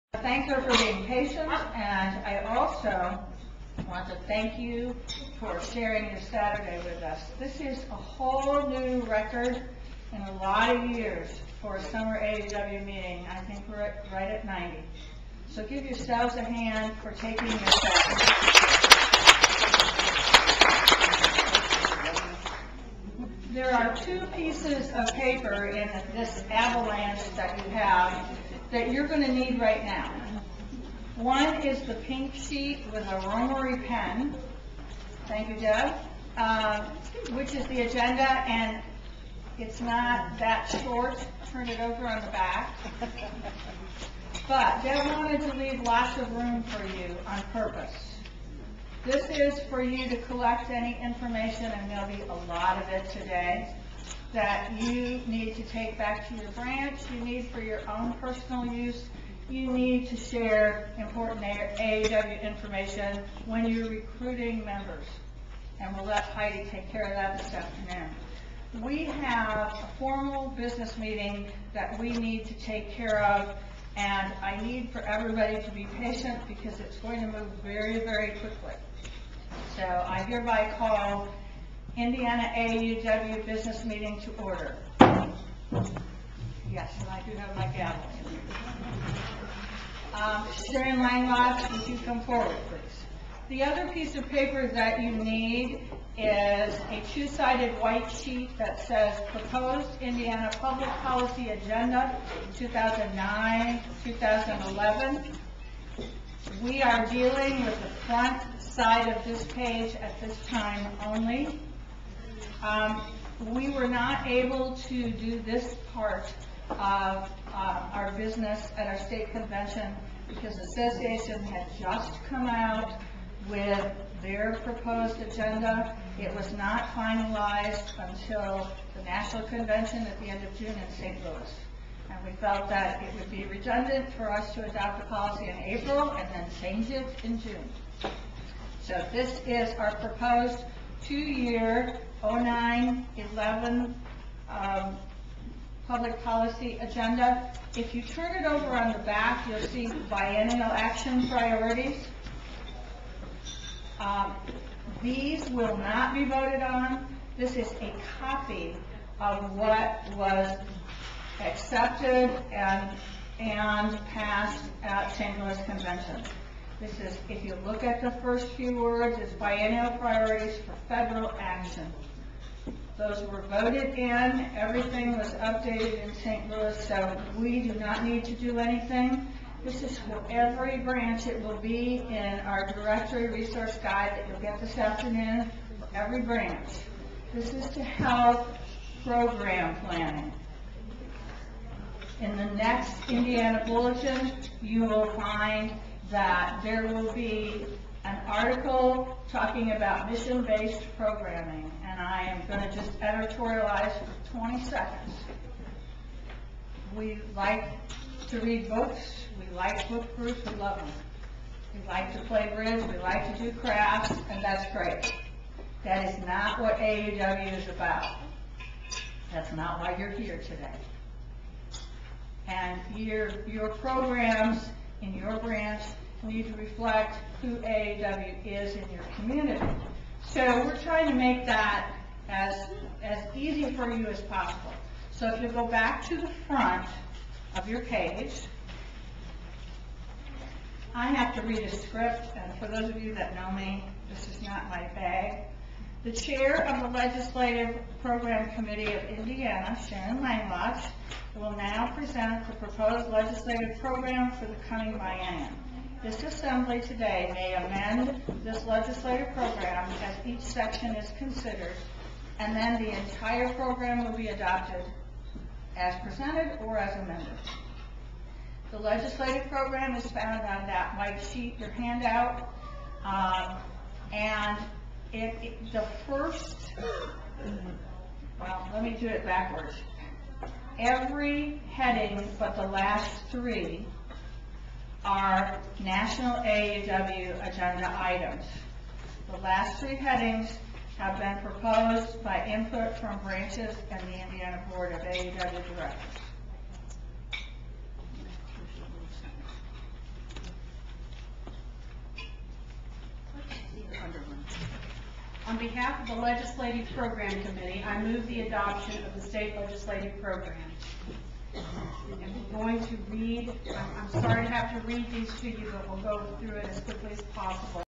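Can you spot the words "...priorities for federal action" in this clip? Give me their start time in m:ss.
2:49.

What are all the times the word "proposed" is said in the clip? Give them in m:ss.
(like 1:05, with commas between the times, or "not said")
1:39, 2:04, 2:19, 4:12, 4:51.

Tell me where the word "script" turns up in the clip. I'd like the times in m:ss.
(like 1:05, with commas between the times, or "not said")
4:01.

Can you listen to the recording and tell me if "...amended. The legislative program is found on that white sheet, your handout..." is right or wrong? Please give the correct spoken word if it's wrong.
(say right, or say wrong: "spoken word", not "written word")
right.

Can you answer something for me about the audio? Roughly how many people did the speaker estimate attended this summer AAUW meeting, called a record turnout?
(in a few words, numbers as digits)
90.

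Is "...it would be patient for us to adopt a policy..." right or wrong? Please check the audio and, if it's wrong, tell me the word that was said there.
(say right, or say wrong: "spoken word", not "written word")
wrong: "redundant", not "patient".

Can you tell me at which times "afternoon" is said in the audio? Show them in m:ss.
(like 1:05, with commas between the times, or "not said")
1:07, 3:04.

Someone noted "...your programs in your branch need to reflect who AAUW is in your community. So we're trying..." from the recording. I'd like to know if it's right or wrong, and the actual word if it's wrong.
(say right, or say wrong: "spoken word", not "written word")
right.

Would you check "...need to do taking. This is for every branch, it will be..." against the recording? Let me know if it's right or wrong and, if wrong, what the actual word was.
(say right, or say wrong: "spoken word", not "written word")
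wrong: "anything", not "taking".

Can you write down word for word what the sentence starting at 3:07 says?
This is to help program planning.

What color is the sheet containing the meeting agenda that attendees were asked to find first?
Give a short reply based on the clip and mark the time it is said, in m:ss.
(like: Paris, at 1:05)
pink, at 0:31.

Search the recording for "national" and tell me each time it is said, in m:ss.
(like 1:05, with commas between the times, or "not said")
2:09, 4:45.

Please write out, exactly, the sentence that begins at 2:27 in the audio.
If you turn it over on the back, you'll see biennial action priorities.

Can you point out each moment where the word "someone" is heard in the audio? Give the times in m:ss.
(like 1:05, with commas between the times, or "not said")
not said.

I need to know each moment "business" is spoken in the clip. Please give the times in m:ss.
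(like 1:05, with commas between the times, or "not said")
1:10, 1:23, 1:58.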